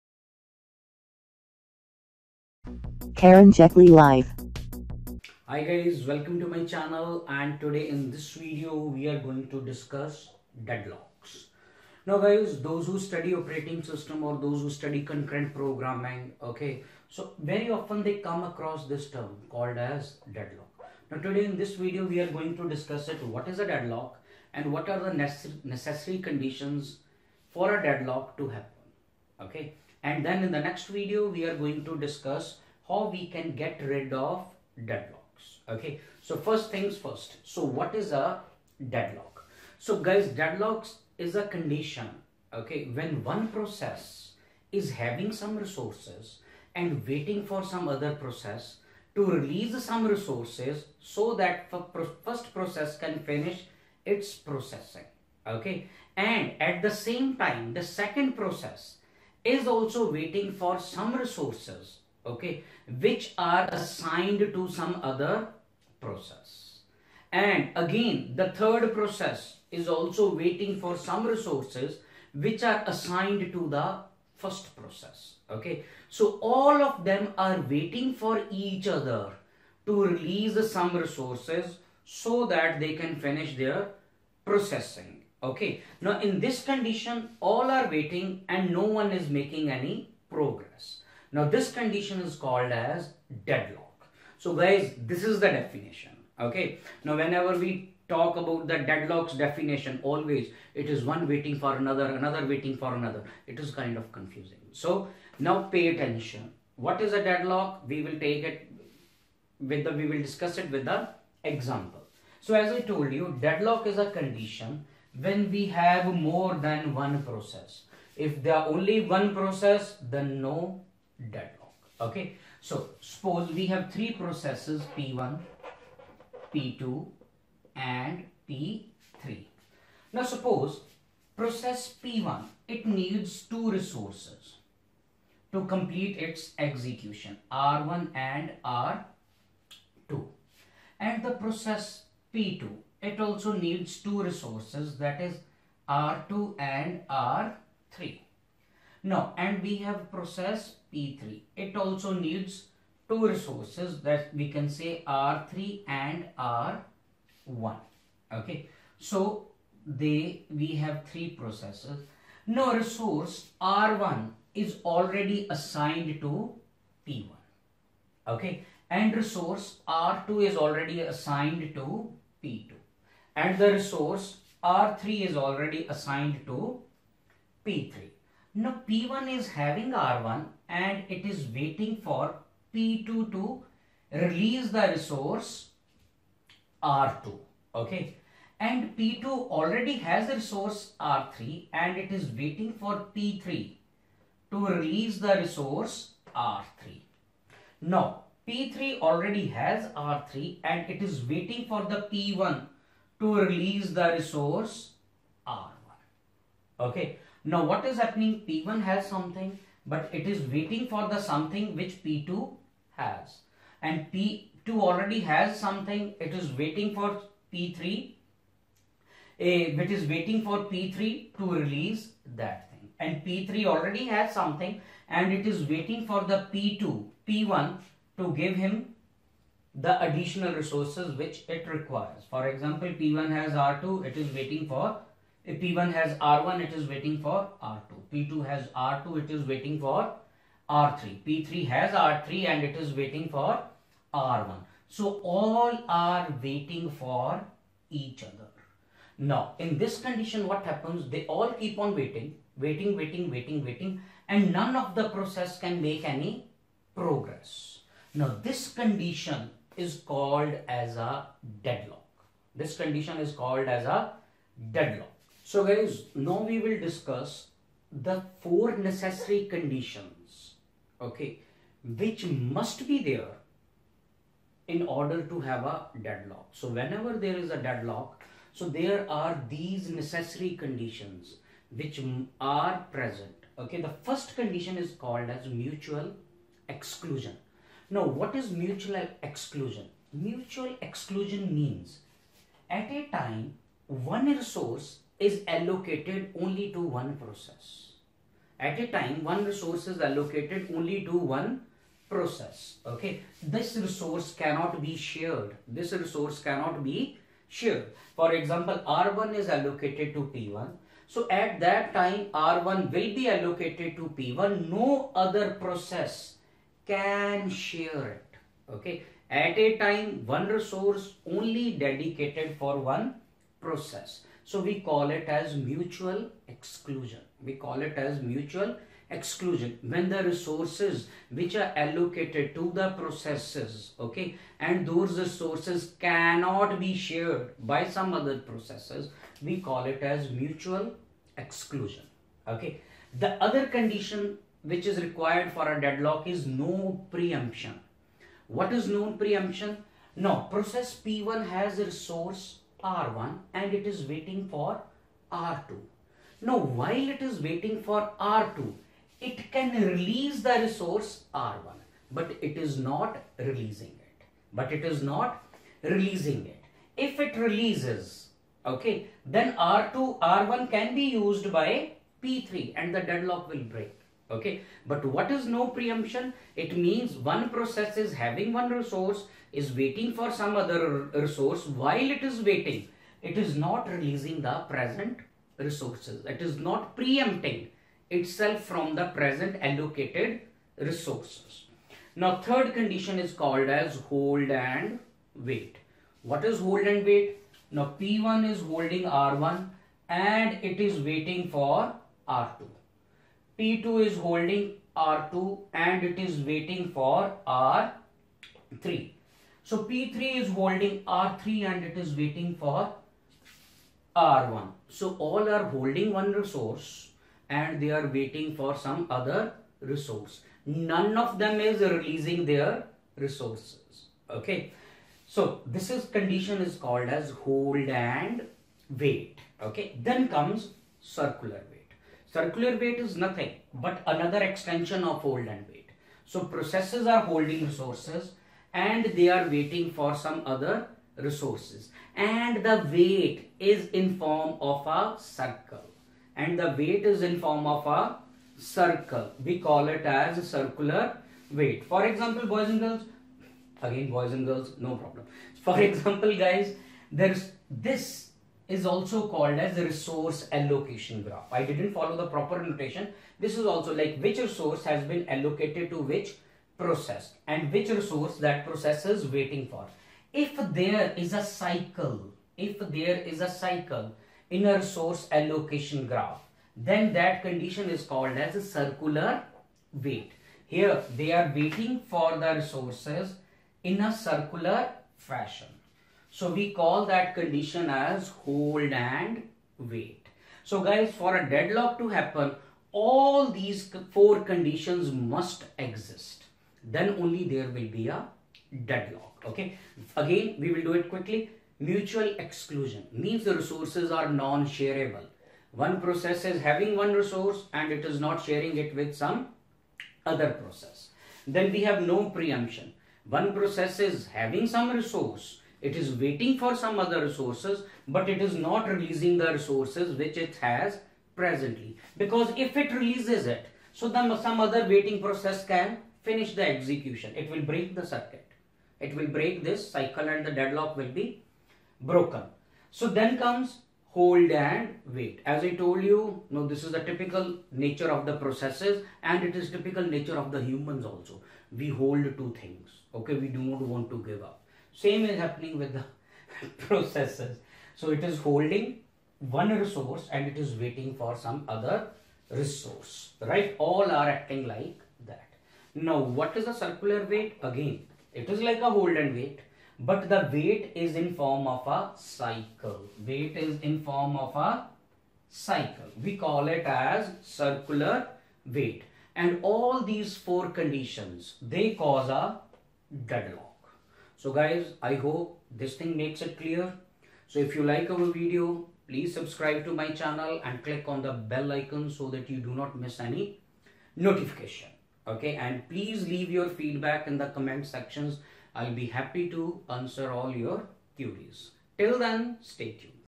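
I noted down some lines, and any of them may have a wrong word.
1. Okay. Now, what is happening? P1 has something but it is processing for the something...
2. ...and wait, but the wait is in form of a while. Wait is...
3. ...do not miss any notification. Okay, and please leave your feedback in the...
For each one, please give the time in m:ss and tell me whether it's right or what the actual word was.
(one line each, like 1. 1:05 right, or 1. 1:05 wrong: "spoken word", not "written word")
1. 3:26 wrong: "waiting", not "processing"
2. 9:19 wrong: "cycle", not "while"
3. 9:42 right.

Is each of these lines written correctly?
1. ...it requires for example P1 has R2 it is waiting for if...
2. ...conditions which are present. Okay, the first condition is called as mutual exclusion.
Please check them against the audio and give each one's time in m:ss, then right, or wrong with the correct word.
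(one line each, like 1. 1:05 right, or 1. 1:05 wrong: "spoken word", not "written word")
1. 3:51 right
2. 4:40 right.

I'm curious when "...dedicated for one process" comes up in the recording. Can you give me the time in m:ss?
5:21.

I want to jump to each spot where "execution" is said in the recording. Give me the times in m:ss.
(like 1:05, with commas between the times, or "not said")
2:16, 8:46.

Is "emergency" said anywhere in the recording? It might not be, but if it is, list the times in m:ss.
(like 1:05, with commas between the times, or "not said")
not said.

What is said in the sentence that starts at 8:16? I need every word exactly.
Then only there will be a deadlock.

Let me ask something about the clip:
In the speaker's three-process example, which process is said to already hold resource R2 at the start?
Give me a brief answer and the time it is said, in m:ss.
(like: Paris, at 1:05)
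P2, at 2:49.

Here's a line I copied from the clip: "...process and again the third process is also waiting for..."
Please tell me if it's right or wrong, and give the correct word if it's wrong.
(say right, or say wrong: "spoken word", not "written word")
right.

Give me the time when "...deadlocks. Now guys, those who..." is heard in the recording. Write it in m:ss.
0:10.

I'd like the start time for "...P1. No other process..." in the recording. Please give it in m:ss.
5:14.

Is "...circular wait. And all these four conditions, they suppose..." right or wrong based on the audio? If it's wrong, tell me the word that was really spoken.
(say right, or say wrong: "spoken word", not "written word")
wrong: "cause", not "suppose".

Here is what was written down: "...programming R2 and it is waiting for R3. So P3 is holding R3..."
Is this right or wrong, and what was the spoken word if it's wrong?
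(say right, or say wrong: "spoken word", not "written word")
wrong: "holding", not "programming".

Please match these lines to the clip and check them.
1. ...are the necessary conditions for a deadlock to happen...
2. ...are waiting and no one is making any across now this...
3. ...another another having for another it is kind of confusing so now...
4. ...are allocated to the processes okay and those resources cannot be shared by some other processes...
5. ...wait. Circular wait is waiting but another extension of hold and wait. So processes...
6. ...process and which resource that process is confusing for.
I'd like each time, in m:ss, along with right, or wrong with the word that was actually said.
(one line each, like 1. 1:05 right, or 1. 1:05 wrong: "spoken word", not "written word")
1. 0:24 right
2. 1:27 wrong: "progress", not "across"
3. 1:41 wrong: "waiting", not "having"
4. 5:31 right
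5. 7:11 wrong: "nothing", not "waiting"
6. 7:46 wrong: "waiting", not "confusing".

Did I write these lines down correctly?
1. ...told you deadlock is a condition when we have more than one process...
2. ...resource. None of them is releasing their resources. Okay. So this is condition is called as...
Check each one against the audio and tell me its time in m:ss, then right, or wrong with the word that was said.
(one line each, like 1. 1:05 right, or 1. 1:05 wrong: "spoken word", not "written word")
1. 1:52 right
2. 6:59 right.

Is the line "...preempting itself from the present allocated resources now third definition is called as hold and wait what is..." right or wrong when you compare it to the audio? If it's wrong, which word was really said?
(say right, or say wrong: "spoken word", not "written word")
wrong: "condition", not "definition".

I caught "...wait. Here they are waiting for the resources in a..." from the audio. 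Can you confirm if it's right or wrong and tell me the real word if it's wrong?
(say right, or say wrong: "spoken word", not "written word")
right.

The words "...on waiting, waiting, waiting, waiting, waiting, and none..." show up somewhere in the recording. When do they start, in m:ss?
4:11.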